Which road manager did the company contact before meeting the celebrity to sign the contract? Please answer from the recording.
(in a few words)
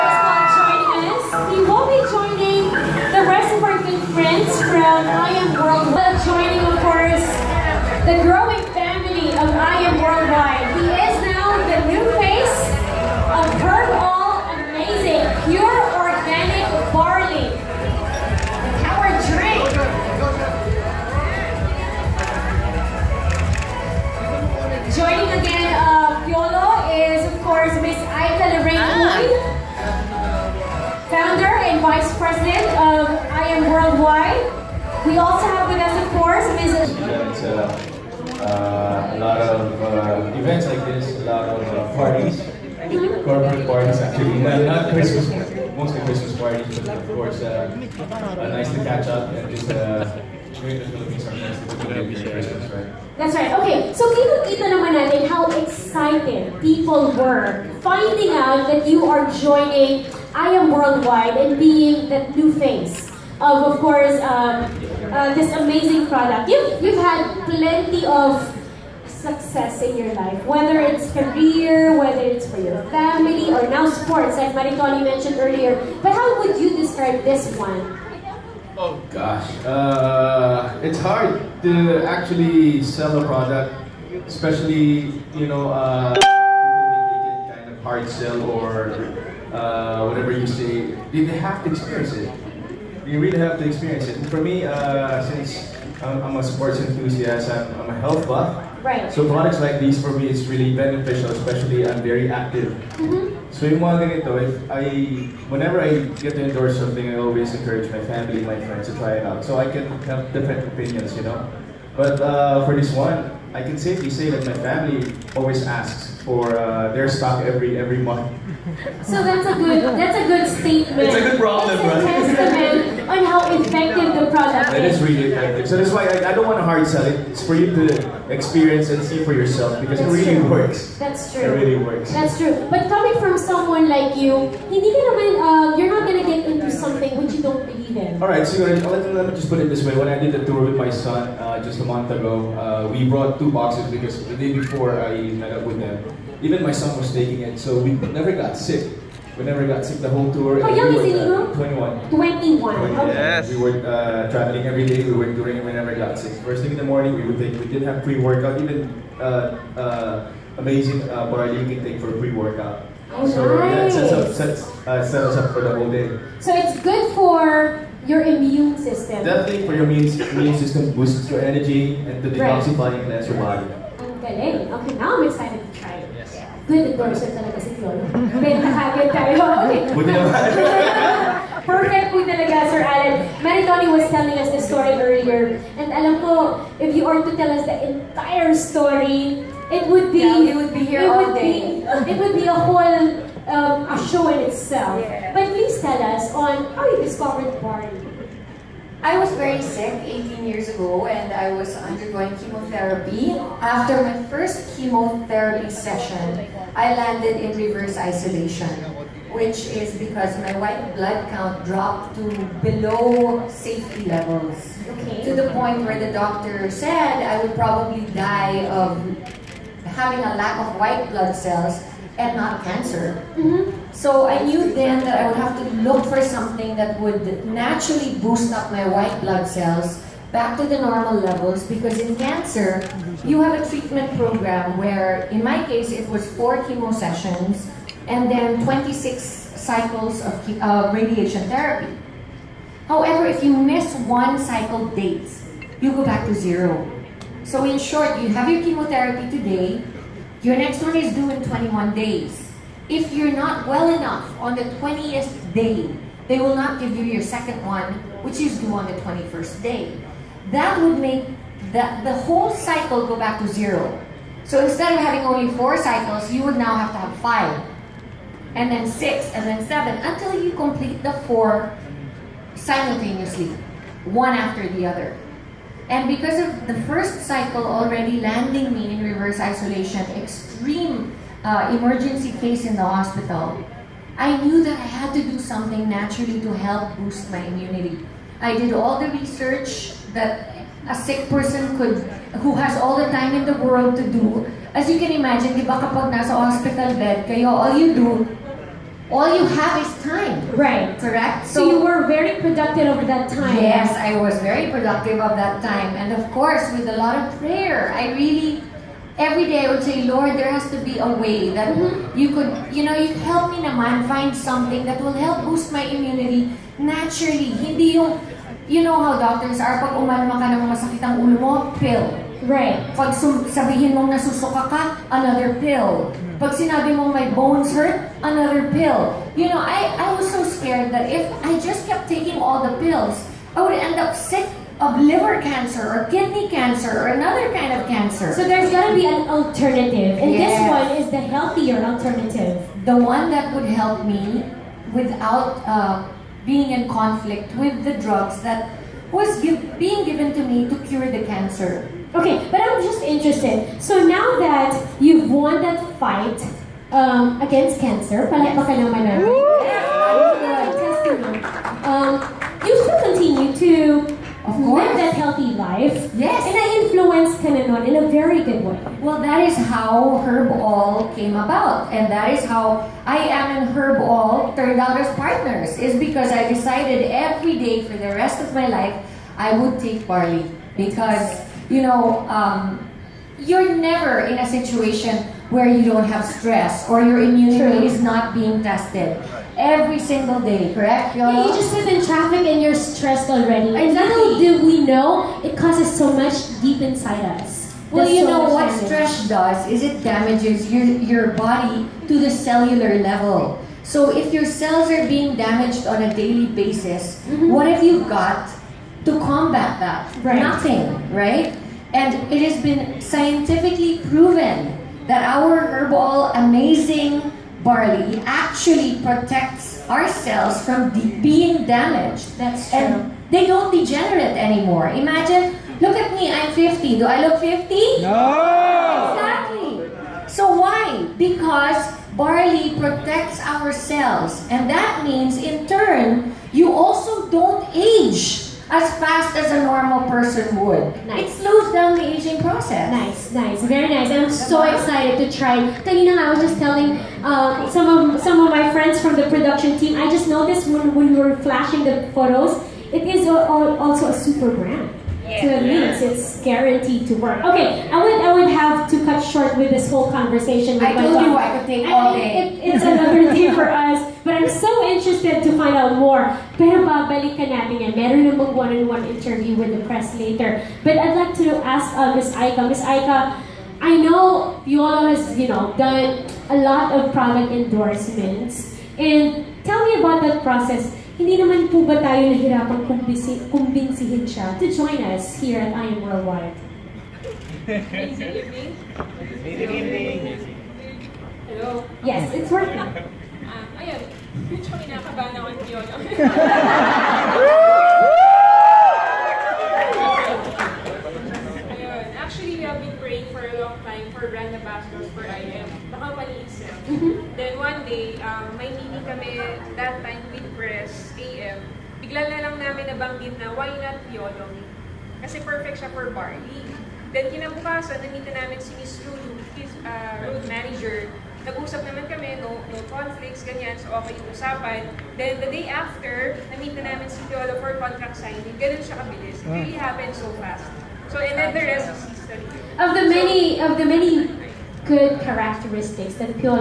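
Miss Lulu.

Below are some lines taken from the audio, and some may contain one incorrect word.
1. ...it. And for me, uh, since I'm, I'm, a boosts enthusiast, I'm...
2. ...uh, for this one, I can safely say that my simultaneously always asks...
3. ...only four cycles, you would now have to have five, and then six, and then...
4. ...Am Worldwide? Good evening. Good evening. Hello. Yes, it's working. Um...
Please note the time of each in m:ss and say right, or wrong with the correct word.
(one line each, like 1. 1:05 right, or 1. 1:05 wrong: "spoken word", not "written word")
1. 1:34 wrong: "sports", not "boosts"
2. 1:52 wrong: "family", not "simultaneously"
3. 4:25 right
4. 8:05 right.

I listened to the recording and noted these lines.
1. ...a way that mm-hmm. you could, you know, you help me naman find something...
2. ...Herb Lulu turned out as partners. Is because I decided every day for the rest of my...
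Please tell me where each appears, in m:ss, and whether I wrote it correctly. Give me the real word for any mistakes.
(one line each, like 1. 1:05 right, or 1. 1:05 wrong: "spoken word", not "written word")
1. 5:10 right
2. 6:13 wrong: "All", not "Lulu".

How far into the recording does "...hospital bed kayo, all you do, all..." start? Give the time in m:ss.
4:56.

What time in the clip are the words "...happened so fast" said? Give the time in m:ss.
8:49.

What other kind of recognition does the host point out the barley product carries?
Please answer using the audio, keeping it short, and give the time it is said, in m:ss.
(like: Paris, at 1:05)
Super brand, at 7:34.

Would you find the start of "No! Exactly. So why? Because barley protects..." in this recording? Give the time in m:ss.
7:08.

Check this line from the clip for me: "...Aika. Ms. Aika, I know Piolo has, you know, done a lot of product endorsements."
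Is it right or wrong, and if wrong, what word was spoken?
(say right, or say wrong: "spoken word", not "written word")
right.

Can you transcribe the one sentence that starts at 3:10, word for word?
Yeah, would be here it all would day.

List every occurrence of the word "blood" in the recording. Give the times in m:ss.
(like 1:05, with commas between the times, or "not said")
3:30, 3:41, 3:49.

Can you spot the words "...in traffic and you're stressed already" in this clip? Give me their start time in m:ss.
6:31.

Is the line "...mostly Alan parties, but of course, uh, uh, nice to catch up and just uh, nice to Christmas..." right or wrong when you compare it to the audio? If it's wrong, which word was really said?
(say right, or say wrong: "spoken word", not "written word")
wrong: "Christmas", not "Alan".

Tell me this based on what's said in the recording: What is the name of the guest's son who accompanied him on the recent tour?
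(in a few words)
Inigo.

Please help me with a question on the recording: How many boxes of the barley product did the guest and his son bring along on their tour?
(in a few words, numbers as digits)
2.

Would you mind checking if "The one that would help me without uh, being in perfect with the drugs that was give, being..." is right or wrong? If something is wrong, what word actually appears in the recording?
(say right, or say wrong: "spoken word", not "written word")
wrong: "conflict", not "perfect".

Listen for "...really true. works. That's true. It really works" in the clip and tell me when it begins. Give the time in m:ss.
2:10.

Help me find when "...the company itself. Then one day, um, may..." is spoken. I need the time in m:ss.
8:25.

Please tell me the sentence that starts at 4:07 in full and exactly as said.
So in short, you have your chemotherapy today, your next one is due in 21 days.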